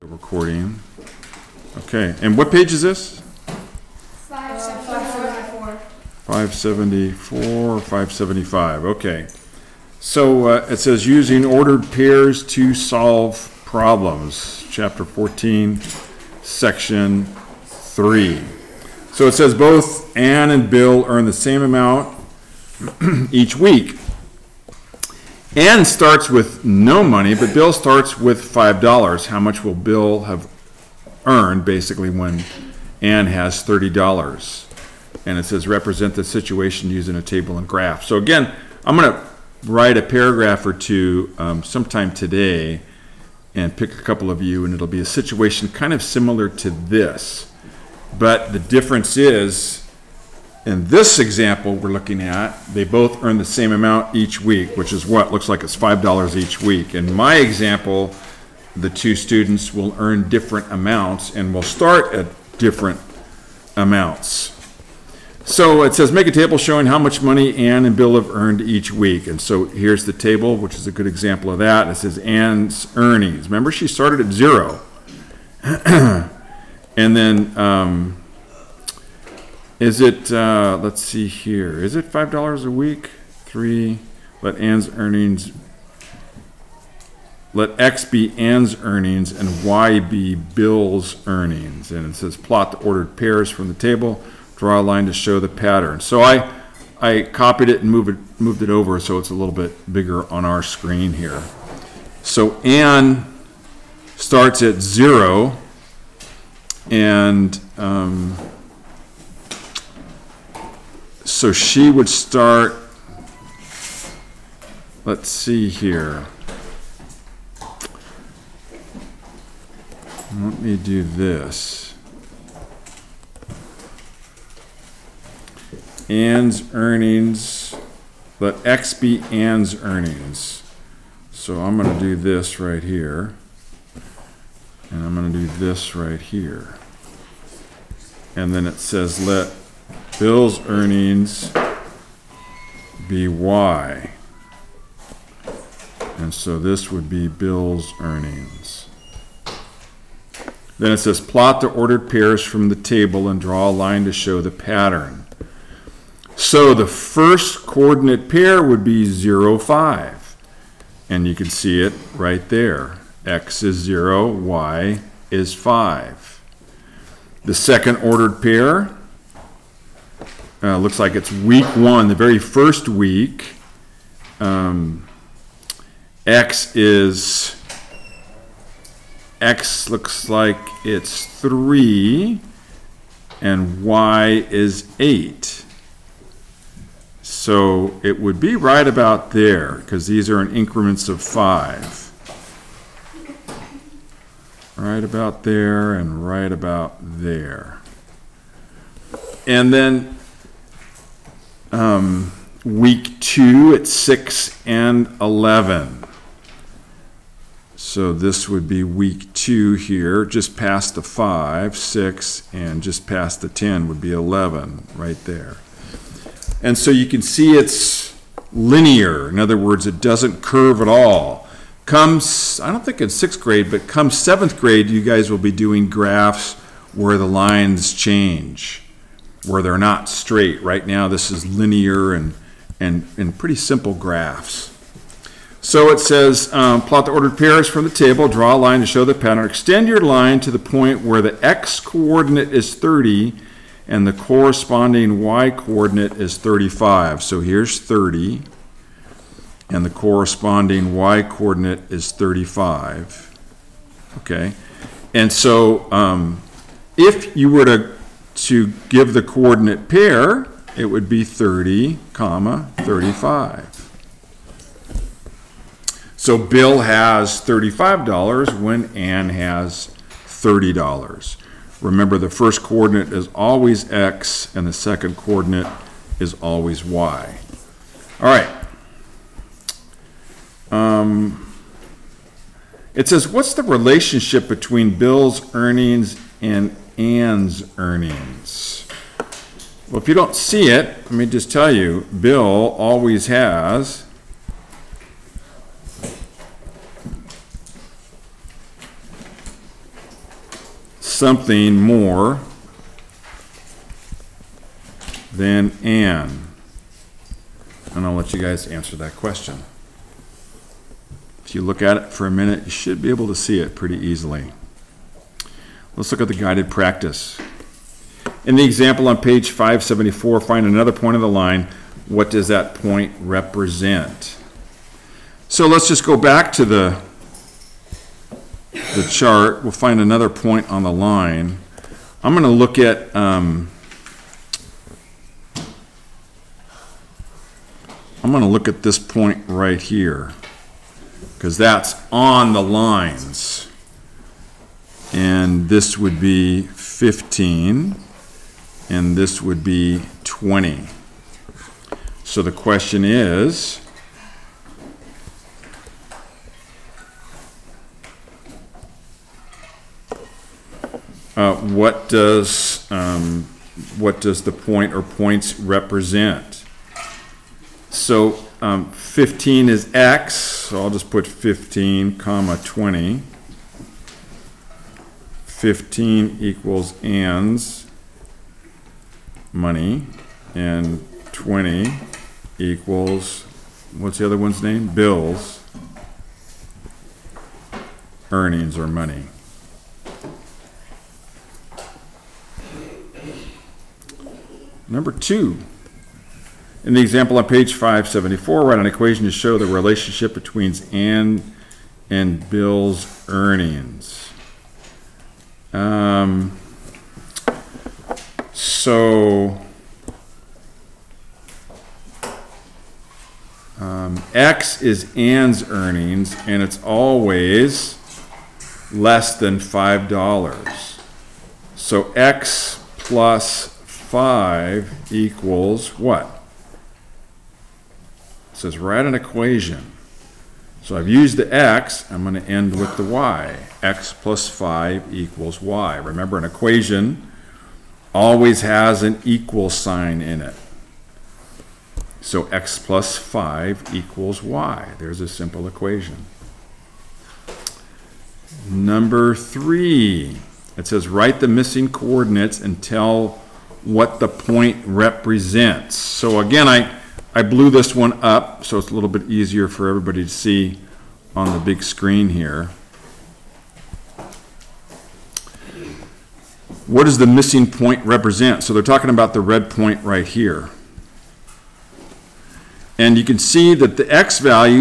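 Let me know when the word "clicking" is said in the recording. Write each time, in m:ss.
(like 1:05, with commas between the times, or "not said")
not said.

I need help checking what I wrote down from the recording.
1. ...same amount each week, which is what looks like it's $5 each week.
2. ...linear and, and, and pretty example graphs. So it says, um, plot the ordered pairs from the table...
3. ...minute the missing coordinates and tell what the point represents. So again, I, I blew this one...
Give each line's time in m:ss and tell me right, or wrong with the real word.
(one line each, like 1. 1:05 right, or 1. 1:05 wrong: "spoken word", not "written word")
1. 0:53 right
2. 3:51 wrong: "simple", not "example"
3. 7:31 wrong: "write", not "minute".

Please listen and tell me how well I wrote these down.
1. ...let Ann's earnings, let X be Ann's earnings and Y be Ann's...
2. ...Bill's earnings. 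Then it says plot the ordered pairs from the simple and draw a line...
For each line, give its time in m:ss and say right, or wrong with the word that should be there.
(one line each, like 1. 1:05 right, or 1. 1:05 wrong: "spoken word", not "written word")
1. 1:24 wrong: "Bill", not "Ann"
2. 2:27 wrong: "table", not "simple".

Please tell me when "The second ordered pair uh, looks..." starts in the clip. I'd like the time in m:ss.
2:47.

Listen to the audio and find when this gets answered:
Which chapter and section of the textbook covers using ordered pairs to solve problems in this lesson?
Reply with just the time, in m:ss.
0:14.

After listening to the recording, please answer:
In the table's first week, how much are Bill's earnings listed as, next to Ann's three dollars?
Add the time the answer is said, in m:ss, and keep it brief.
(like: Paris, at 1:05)
8, at 3:03.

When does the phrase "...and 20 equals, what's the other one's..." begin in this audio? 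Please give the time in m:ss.
6:20.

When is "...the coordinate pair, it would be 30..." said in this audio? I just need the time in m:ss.
4:19.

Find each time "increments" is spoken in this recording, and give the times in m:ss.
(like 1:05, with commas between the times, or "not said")
3:10.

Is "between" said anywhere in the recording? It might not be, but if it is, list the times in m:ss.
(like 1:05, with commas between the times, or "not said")
4:44, 6:40.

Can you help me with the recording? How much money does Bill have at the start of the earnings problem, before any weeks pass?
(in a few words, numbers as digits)
$5.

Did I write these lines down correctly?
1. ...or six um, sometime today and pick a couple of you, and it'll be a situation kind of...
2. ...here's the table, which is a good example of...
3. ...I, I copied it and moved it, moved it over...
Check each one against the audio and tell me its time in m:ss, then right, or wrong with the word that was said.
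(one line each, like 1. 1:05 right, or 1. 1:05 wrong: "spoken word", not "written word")
1. 0:40 wrong: "two", not "six"
2. 1:09 right
3. 1:36 right.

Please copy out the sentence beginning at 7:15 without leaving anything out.
Remember, an equation always has an equal sign in it.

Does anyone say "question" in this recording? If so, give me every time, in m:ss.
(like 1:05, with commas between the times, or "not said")
5:09, 5:52.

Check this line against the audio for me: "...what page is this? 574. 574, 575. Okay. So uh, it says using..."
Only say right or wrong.
right.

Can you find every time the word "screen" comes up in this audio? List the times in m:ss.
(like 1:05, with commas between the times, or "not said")
1:40, 7:41.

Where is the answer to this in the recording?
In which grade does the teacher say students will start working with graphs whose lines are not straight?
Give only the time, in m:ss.
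3:44.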